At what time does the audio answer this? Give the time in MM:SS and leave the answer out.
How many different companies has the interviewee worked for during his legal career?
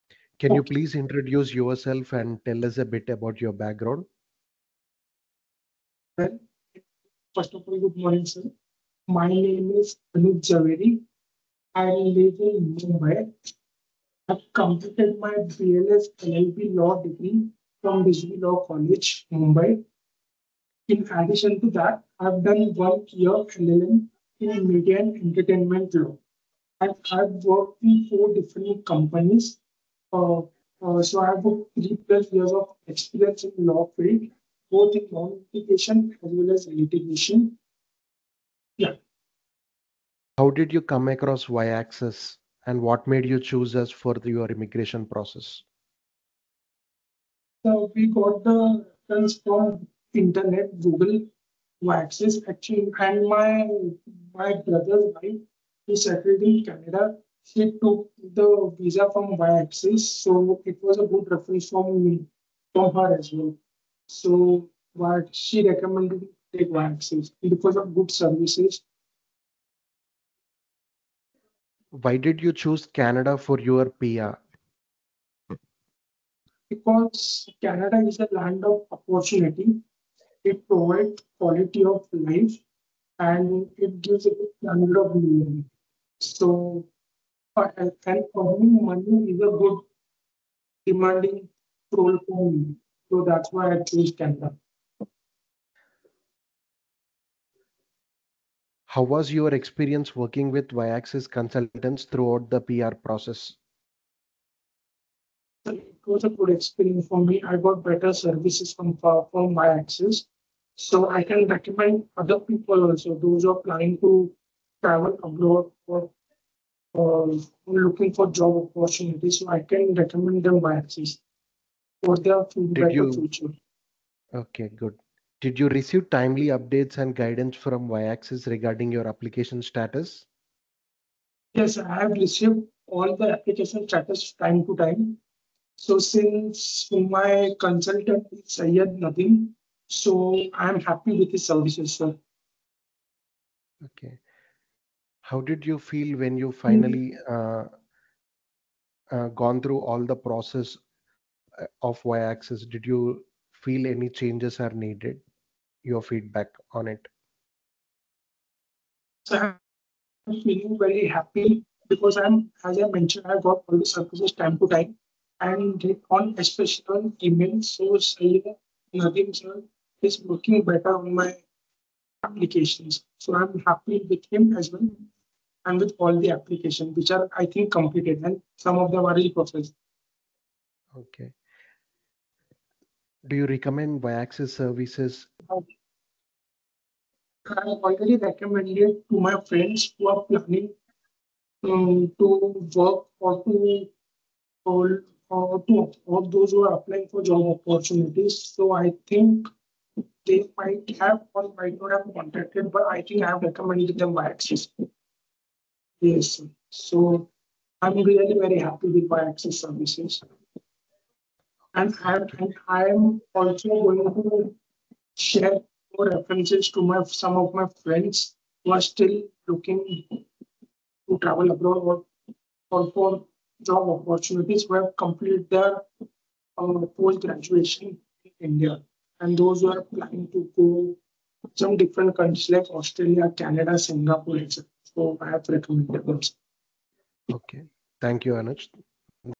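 00:28.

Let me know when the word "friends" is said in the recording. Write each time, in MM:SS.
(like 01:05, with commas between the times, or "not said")
03:09, 03:37.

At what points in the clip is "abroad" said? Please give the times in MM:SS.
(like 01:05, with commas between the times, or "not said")
01:55, 03:41.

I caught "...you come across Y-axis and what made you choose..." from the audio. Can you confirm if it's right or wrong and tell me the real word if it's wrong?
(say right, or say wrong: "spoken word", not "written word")
right.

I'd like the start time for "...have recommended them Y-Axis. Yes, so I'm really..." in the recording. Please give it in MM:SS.
03:23.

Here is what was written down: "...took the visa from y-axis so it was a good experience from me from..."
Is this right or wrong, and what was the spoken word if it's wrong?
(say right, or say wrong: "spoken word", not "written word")
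wrong: "reference", not "experience".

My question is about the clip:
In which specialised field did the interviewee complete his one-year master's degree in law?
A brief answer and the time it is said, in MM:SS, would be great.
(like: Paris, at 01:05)
Media and entertainment law, at 00:24.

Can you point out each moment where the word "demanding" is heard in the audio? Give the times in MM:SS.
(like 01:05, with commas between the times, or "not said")
01:30.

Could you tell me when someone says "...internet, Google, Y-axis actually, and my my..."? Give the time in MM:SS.
00:50.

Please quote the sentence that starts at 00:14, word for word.
I've completed my BLS LLB law degree from Vishnu Law College, Mumbai.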